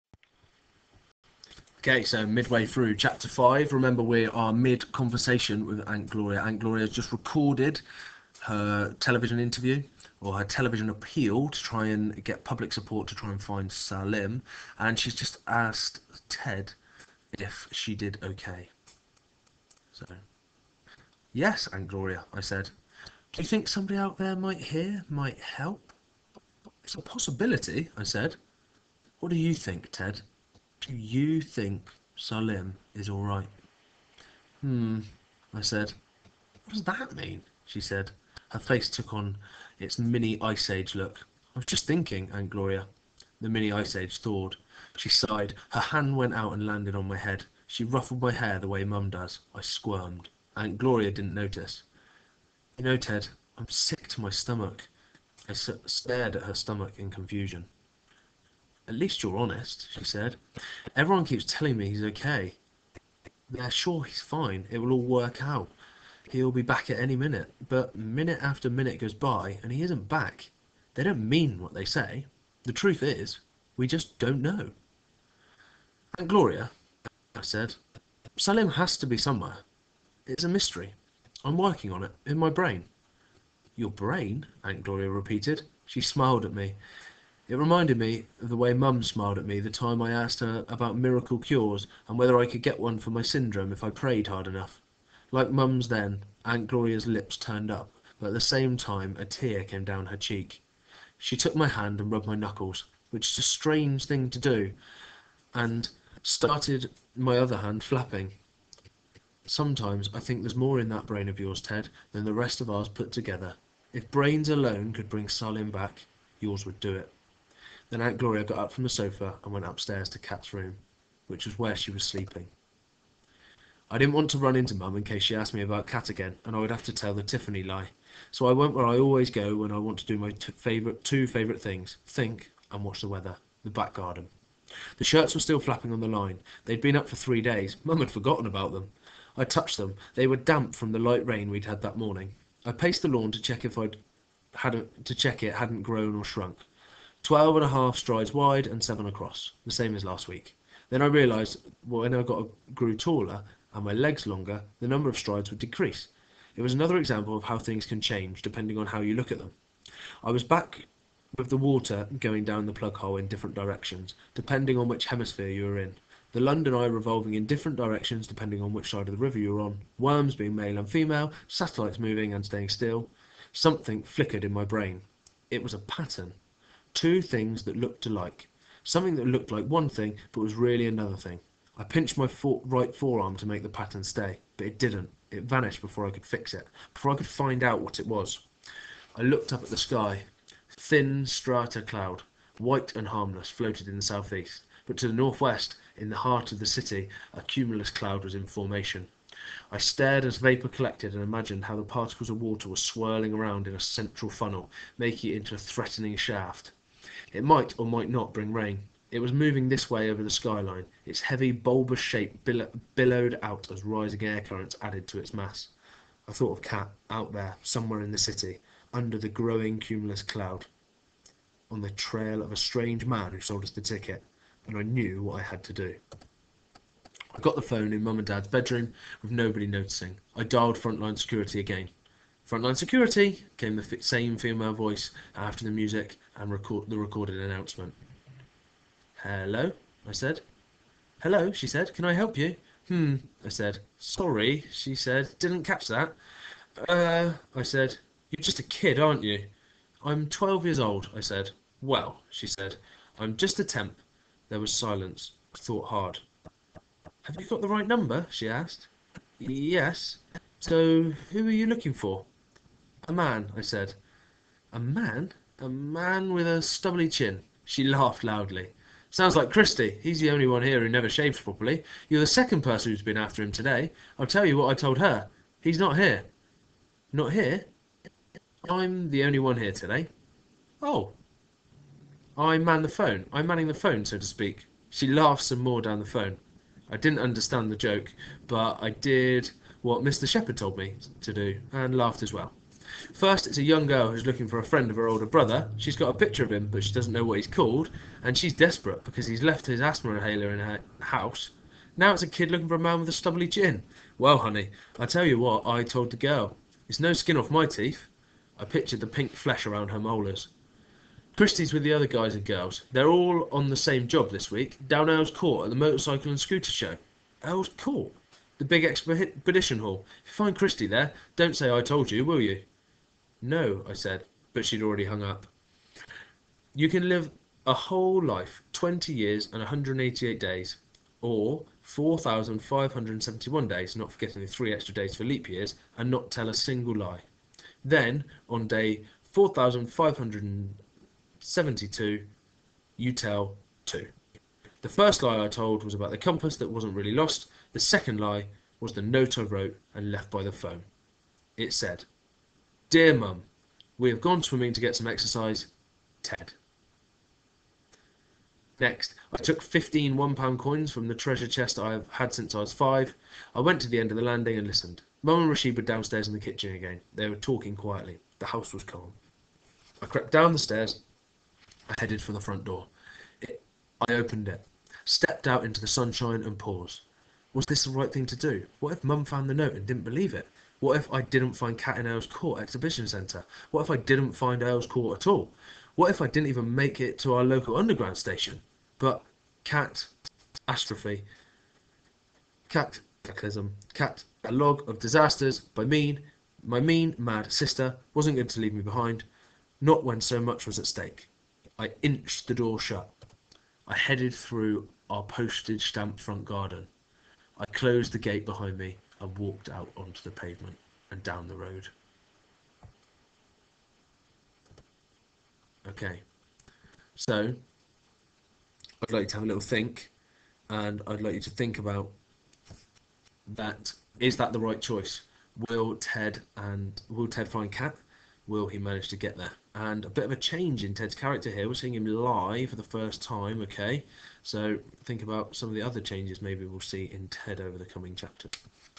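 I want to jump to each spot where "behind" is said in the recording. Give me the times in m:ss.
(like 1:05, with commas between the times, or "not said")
6:38, 6:48.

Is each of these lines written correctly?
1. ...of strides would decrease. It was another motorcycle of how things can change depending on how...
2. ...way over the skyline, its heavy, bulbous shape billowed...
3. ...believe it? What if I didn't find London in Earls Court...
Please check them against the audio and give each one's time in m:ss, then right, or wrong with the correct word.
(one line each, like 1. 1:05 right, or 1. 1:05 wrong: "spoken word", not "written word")
1. 2:35 wrong: "example", not "motorcycle"
2. 3:29 right
3. 6:20 wrong: "Kat", not "London".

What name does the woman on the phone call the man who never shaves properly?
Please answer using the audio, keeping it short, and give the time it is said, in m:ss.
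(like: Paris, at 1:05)
Christy, at 4:29.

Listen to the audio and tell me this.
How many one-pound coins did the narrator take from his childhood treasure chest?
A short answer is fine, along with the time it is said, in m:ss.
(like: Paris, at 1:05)
15, at 5:59.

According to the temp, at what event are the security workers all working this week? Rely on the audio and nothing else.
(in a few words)
motorcycle and scooter show.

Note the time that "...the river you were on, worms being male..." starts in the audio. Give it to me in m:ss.
2:49.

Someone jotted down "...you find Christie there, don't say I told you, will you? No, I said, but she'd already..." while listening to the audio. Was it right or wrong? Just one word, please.
right.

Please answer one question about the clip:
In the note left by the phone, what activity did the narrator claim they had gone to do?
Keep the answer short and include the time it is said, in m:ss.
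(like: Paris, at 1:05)
swimming, at 5:54.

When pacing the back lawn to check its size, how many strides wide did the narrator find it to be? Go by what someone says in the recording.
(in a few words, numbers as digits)
12 and a half.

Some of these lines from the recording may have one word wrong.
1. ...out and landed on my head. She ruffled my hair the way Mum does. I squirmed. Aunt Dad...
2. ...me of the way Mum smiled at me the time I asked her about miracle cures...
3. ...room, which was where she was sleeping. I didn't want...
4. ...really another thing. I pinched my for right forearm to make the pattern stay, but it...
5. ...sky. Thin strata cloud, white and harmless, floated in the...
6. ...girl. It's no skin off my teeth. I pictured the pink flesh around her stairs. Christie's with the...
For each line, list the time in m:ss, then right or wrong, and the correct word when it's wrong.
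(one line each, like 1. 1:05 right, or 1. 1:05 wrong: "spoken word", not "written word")
1. 0:46 wrong: "Gloria", not "Dad"
2. 1:27 right
3. 2:00 right
4. 3:00 right
5. 3:09 right
6. 5:06 wrong: "molars", not "stairs".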